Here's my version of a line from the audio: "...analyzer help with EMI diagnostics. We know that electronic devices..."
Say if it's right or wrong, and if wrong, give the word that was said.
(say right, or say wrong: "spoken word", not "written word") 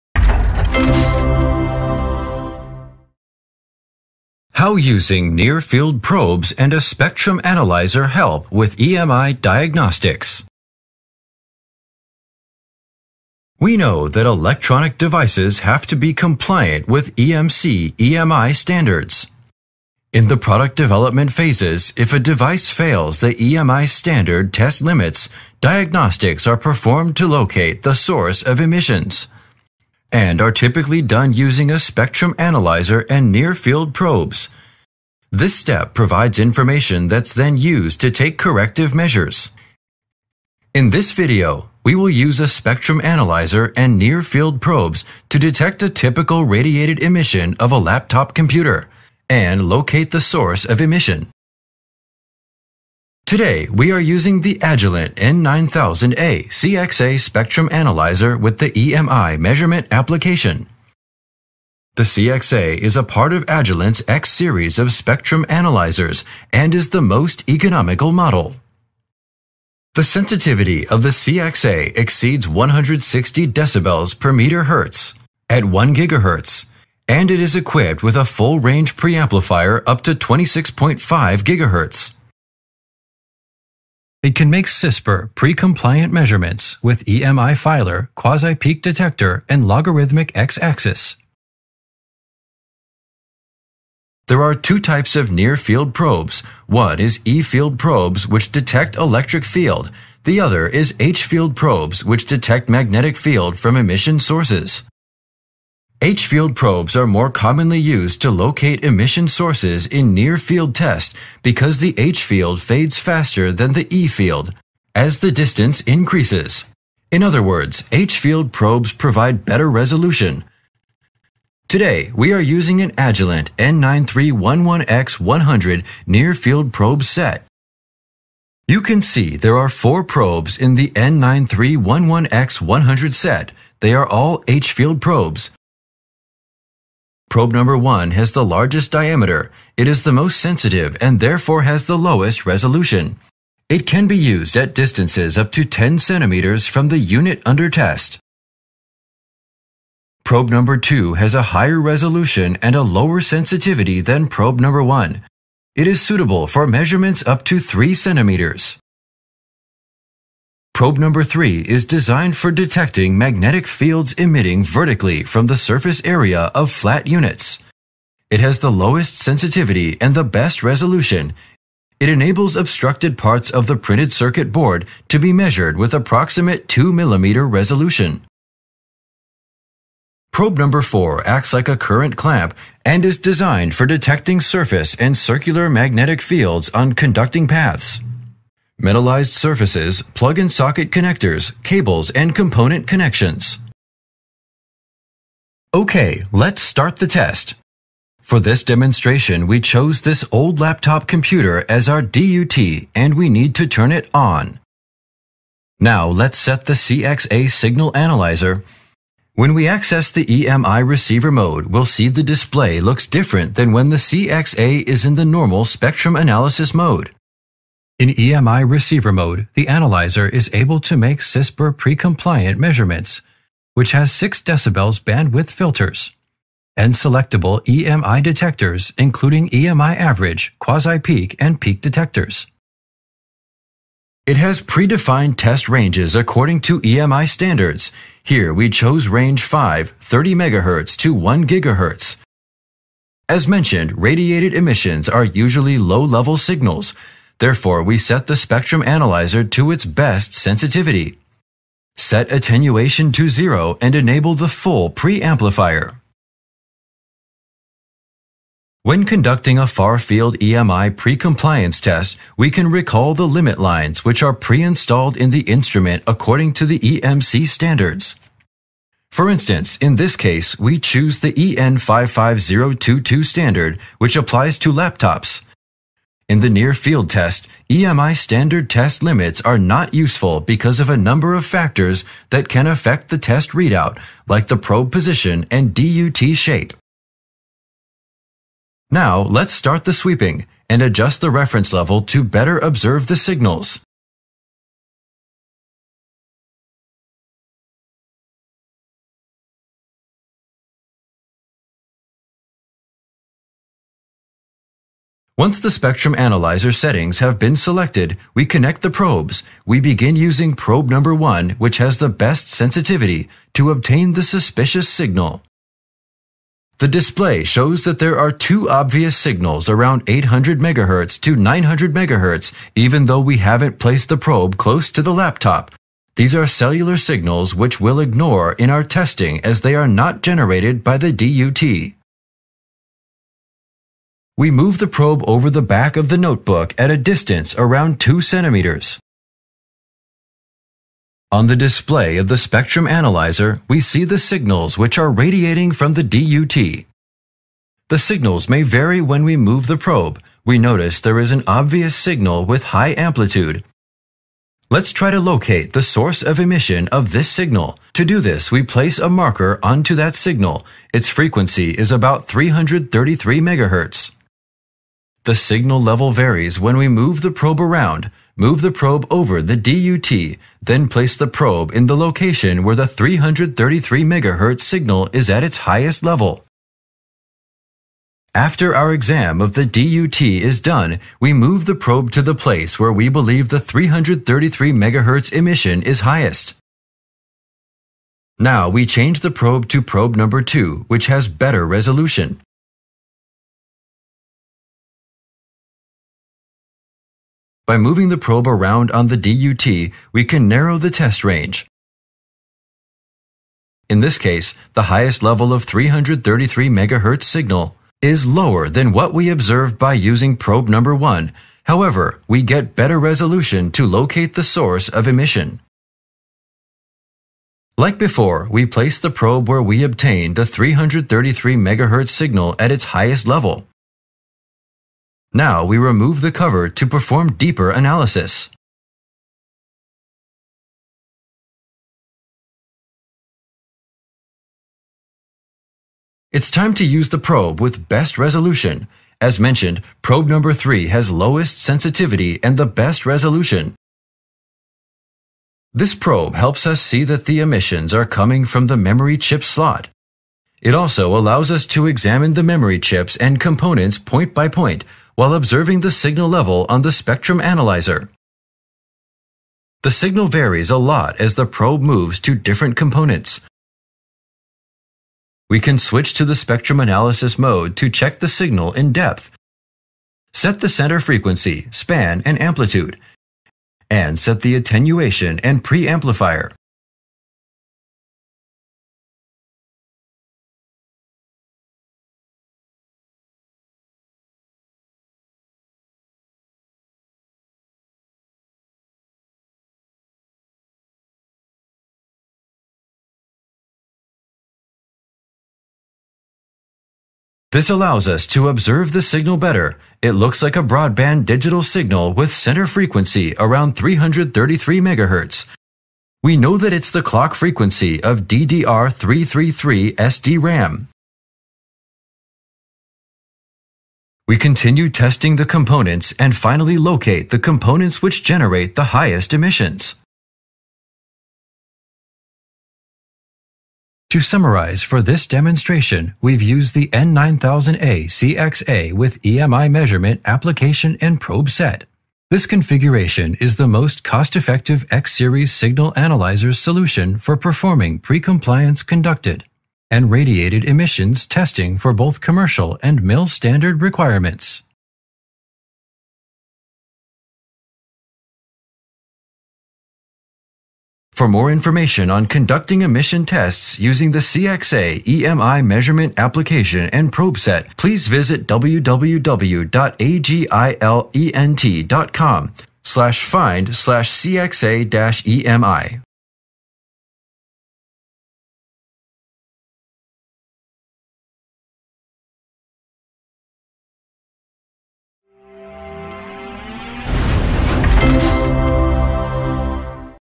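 right.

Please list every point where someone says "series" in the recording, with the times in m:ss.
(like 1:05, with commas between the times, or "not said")
1:04, 8:54.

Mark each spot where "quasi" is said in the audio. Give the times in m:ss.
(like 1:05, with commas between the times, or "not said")
1:28, 3:50.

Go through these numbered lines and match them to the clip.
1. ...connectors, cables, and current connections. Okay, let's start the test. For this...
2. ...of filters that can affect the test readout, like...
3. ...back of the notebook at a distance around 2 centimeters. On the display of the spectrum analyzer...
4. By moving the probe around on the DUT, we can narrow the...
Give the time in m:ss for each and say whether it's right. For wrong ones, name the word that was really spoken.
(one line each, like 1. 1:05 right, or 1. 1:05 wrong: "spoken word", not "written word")
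1. 3:10 wrong: "component", not "current"
2. 4:41 wrong: "factors", not "filters"
3. 5:35 right
4. 6:37 right.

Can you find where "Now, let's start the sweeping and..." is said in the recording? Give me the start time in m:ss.
4:48.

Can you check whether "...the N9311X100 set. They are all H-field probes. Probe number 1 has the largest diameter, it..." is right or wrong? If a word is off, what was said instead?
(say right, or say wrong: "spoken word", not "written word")
right.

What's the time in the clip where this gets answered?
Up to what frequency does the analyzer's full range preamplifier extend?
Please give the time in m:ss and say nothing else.
1:20.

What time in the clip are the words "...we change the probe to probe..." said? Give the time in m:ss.
6:28.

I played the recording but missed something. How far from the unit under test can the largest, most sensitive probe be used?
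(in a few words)
10 centimeters.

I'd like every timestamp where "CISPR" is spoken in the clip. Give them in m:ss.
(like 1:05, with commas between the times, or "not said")
1:24, 3:41.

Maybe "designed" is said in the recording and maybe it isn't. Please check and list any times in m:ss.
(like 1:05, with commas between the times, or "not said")
2:41, 3:03.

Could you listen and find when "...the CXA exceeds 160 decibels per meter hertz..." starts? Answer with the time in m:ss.
1:11.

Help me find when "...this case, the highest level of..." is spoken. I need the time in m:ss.
6:44.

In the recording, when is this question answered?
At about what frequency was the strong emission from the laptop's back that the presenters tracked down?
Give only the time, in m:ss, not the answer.
6:02.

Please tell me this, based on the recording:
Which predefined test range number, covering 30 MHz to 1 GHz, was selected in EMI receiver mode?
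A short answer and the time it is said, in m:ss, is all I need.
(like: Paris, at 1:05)
5, at 3:59.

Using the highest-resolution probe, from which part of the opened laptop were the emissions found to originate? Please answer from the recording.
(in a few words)
memory chip slot.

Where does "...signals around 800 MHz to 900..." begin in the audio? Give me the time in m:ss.
5:19.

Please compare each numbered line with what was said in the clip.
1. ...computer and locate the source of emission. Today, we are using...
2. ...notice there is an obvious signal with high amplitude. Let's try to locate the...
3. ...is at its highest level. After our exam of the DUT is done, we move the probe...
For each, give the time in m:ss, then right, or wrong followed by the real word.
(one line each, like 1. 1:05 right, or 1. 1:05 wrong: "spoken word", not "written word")
1. 0:48 right
2. 5:50 right
3. 6:15 right.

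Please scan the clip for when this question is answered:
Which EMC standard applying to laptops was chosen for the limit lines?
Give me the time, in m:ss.
4:31.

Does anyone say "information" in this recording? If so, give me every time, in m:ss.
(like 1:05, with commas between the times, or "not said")
0:36, 9:11.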